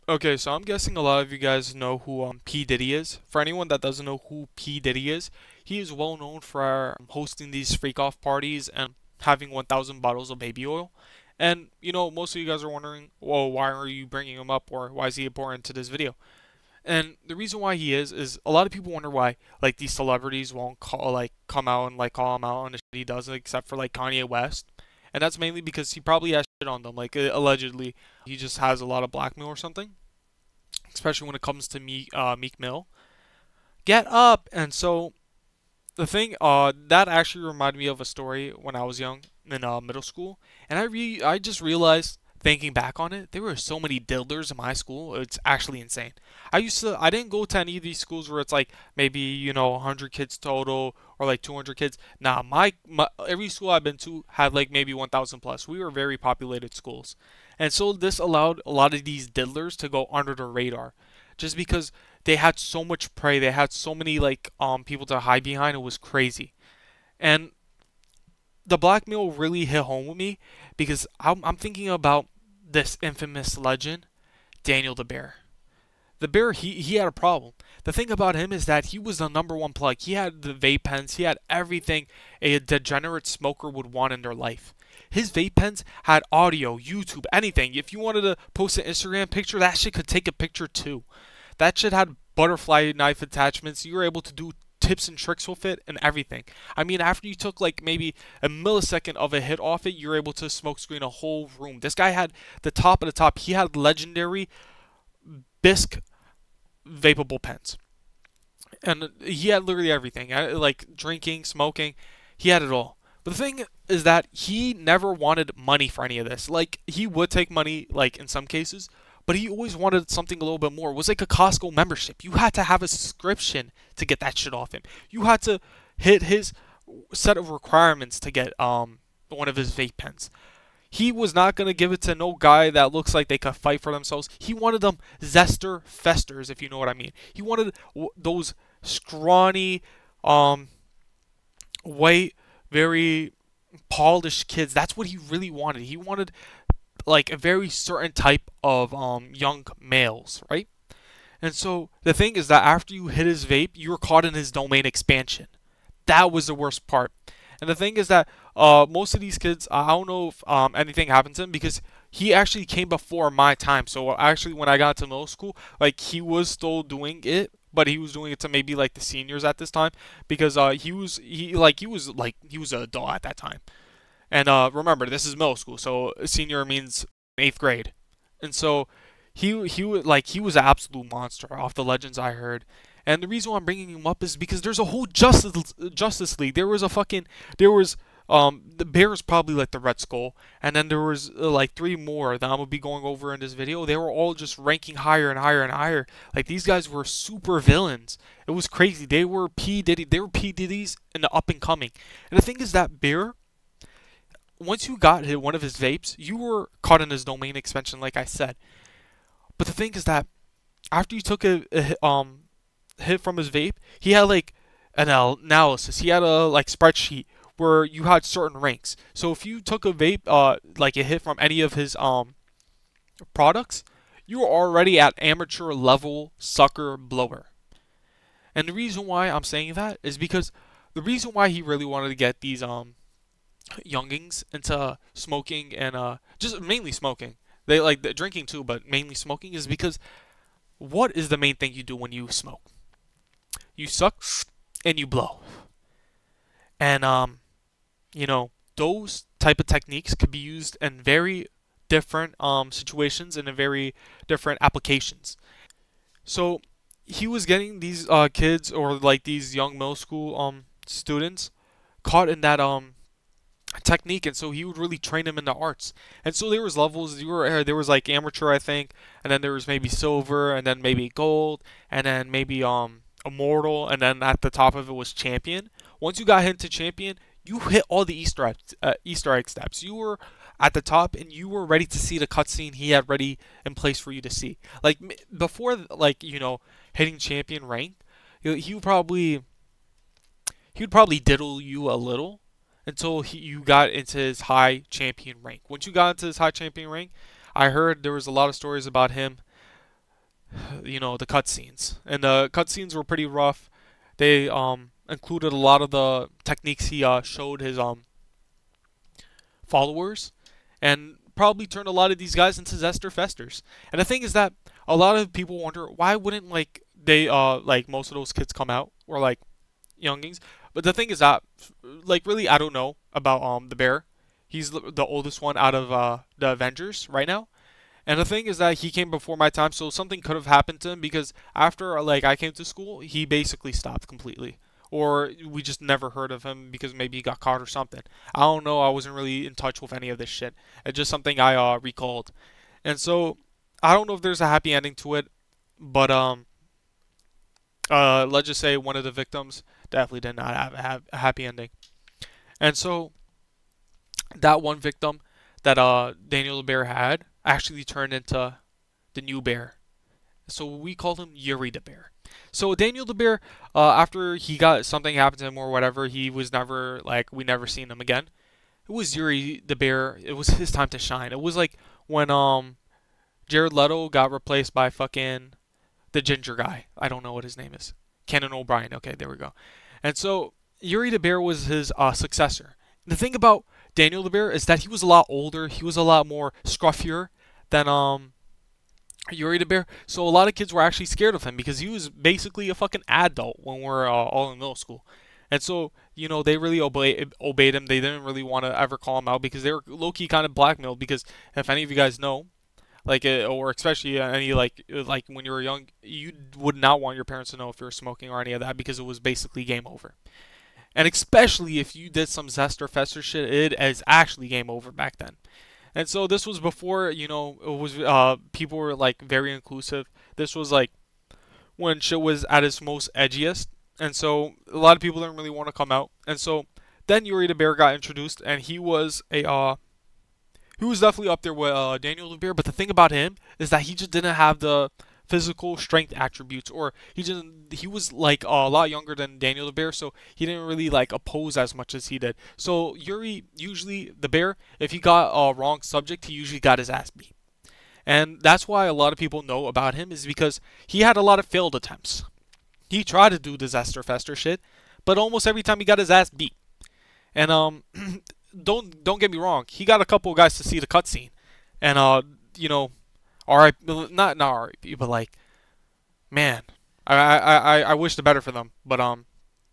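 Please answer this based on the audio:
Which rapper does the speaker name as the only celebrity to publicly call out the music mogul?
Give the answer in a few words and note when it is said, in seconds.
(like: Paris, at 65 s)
Kanye West, at 23 s.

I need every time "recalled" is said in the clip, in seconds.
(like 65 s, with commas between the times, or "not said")
341 s.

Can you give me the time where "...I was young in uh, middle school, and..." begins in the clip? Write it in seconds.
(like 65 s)
38 s.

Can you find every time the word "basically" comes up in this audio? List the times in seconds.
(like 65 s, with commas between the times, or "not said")
333 s, 392 s, 409 s.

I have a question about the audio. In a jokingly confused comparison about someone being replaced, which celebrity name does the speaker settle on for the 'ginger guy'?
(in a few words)
Conan O'Brien.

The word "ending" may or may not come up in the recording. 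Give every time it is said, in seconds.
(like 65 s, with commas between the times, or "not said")
344 s, 351 s.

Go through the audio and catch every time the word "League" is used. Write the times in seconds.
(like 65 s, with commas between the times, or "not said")
186 s.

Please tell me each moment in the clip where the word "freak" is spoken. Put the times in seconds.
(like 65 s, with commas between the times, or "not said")
7 s.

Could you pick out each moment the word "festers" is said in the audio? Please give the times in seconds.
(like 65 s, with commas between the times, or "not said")
135 s, 313 s, 412 s, 454 s.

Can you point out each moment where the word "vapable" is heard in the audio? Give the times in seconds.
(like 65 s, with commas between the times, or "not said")
106 s.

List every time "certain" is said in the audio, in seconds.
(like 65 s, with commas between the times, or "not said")
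147 s, 218 s.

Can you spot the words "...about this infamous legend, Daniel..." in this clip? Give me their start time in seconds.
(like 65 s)
71 s.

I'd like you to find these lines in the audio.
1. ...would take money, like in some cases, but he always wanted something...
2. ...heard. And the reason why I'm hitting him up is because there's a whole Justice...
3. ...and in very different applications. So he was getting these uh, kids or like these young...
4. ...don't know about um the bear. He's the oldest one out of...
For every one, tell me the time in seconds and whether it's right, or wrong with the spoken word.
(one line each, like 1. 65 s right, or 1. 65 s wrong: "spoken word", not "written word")
1. 117 s right
2. 182 s wrong: "bringing", not "hitting"
3. 253 s right
4. 322 s right.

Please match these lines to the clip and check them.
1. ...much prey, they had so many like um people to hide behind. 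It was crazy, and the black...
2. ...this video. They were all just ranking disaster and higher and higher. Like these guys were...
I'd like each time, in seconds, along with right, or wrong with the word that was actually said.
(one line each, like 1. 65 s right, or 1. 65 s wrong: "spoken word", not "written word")
1. 62 s right
2. 193 s wrong: "higher", not "disaster".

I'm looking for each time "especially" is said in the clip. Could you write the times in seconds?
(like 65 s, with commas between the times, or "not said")
30 s, 403 s, 411 s.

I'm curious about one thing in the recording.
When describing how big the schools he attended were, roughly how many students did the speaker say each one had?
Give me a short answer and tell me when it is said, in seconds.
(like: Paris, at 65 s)
1,000 plus, at 54 s.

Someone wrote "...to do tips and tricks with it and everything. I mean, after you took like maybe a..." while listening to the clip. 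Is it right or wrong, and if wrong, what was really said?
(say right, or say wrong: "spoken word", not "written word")
right.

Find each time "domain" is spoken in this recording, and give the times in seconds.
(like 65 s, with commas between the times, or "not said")
154 s, 207 s.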